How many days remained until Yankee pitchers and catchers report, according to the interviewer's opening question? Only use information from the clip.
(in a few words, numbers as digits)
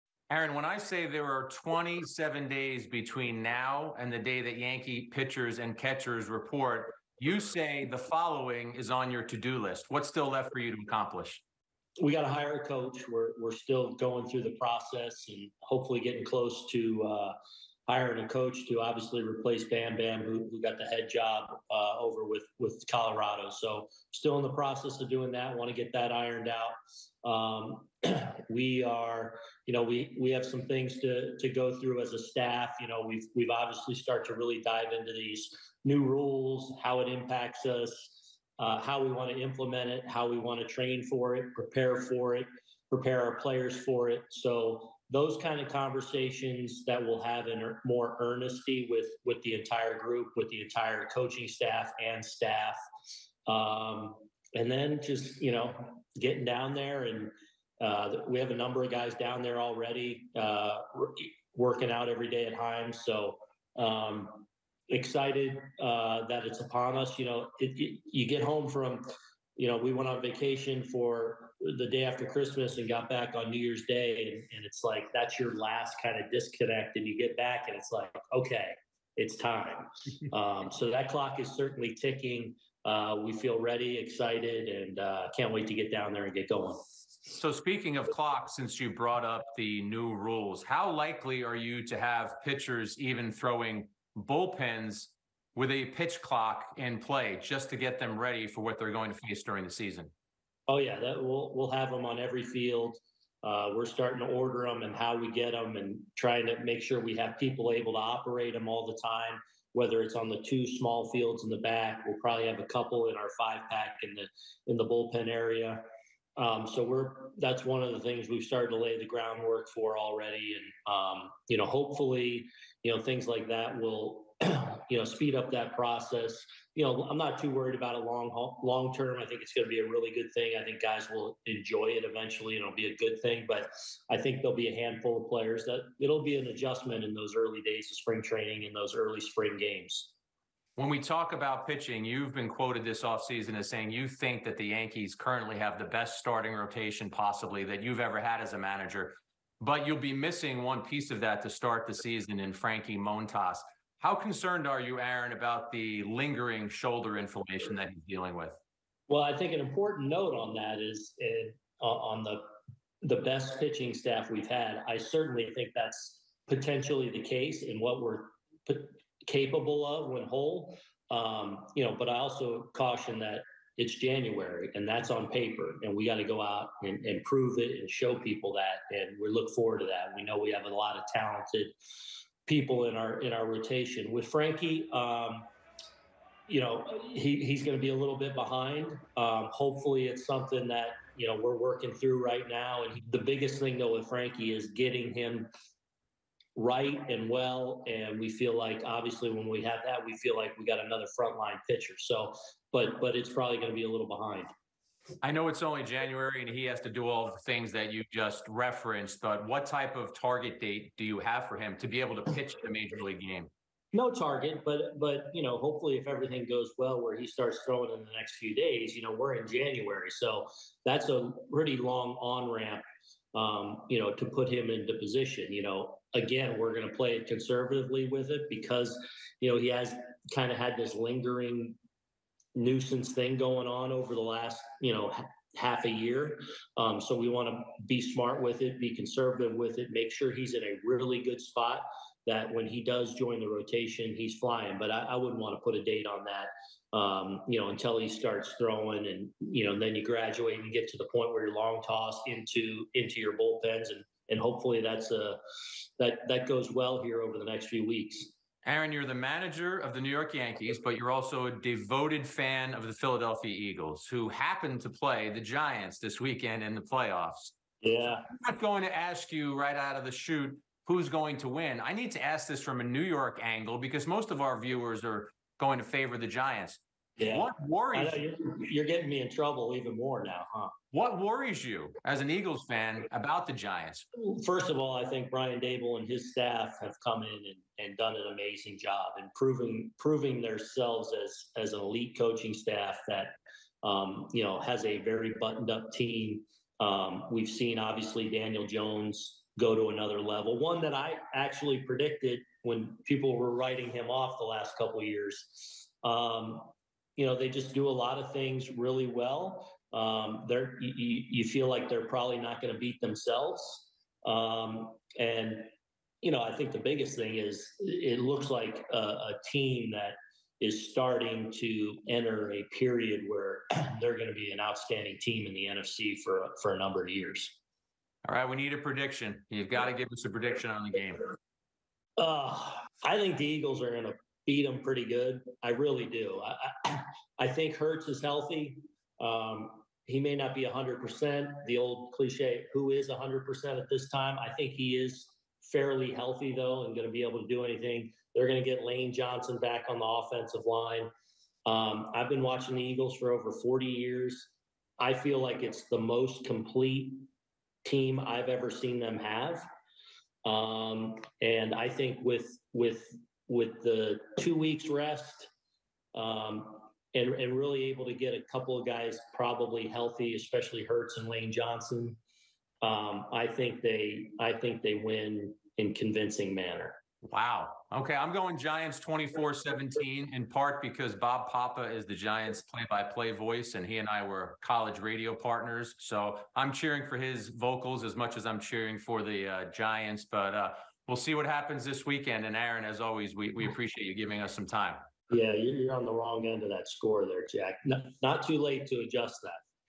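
27.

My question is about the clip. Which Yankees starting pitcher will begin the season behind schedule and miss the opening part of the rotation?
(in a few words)
Frankie Montas.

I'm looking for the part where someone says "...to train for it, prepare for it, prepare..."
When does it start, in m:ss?
0:40.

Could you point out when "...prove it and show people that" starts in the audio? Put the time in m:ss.
2:57.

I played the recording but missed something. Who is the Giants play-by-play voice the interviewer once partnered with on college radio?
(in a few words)
Bob Papa.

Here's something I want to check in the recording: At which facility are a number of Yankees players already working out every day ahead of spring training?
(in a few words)
Himes.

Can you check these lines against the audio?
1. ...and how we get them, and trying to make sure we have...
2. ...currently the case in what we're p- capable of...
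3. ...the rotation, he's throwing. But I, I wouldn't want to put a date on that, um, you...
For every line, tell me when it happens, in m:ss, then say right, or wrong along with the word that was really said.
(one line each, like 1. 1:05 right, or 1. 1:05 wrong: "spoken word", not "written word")
1. 1:44 right
2. 2:46 wrong: "potentially", not "currently"
3. 4:03 wrong: "flying", not "throwing".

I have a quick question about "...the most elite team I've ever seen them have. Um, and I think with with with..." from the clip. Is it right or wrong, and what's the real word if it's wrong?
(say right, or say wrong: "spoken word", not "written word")
wrong: "complete", not "elite".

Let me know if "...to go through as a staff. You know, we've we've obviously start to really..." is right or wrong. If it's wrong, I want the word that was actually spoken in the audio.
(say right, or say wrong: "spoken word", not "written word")
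right.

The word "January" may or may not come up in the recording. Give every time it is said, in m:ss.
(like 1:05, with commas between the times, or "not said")
2:53, 3:25, 3:39.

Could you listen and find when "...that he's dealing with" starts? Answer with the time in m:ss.
2:37.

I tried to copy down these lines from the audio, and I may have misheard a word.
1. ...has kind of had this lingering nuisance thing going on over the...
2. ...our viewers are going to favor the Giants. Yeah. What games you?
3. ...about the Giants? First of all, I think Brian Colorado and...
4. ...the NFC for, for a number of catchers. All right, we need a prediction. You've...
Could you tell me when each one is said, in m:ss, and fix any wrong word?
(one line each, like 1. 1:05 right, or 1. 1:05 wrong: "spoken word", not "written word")
1. 3:49 right
2. 4:34 wrong: "worries", not "games"
3. 4:43 wrong: "Daboll", not "Colorado"
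4. 5:25 wrong: "years", not "catchers".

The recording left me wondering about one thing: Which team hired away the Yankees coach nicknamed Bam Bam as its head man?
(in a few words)
Colorado.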